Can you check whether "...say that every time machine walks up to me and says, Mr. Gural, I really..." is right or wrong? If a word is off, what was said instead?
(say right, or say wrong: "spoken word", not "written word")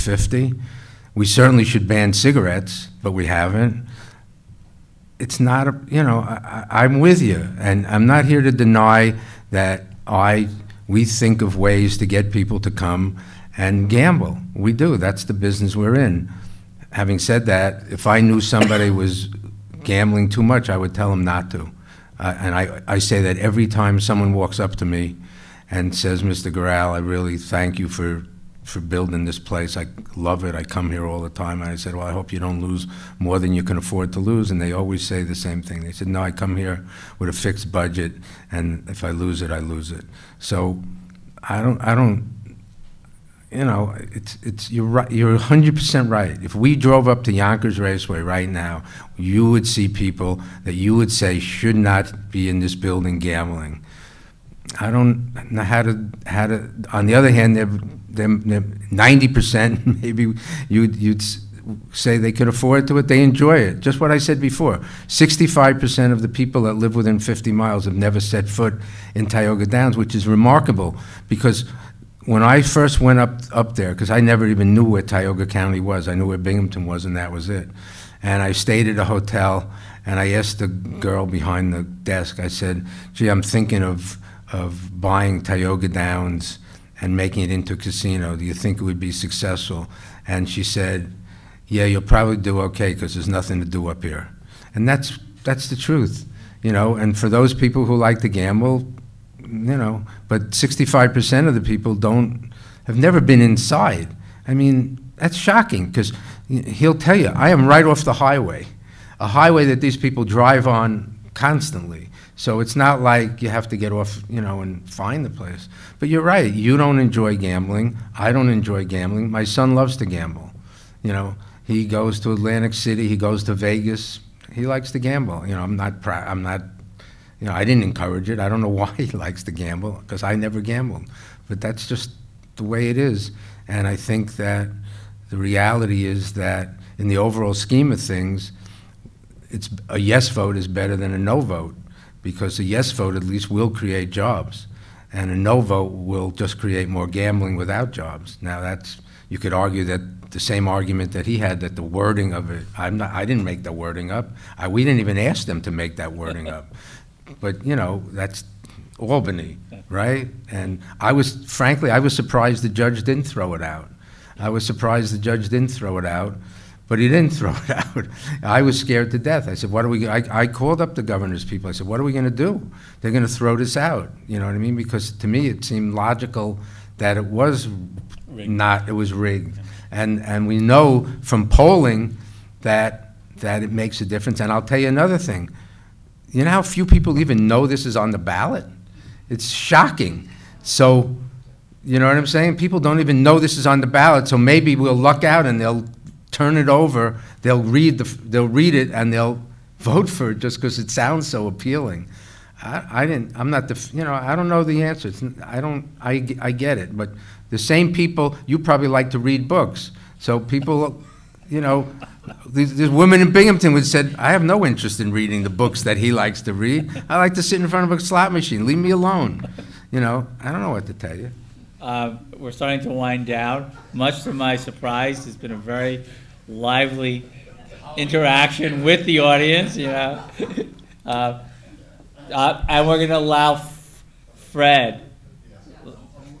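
wrong: "someone", not "machine".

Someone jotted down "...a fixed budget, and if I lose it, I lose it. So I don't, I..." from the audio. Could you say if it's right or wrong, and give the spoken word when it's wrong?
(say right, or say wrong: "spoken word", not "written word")
right.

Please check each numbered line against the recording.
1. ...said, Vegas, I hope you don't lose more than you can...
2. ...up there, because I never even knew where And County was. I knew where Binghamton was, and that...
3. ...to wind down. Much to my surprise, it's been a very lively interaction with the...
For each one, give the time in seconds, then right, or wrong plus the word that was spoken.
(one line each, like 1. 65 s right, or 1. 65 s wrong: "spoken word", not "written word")
1. 31 s wrong: "Well", not "Vegas"
2. 73 s wrong: "Tioga", not "And"
3. 222 s right.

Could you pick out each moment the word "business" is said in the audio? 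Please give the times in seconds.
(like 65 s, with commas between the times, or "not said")
15 s.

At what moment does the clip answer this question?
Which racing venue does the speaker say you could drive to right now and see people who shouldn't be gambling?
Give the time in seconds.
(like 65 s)
47 s.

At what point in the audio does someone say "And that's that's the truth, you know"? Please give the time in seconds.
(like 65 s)
94 s.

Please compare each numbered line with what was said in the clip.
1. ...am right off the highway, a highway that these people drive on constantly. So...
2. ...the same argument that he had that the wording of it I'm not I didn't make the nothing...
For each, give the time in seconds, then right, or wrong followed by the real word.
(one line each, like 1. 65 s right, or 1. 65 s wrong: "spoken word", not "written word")
1. 107 s right
2. 150 s wrong: "wording", not "nothing".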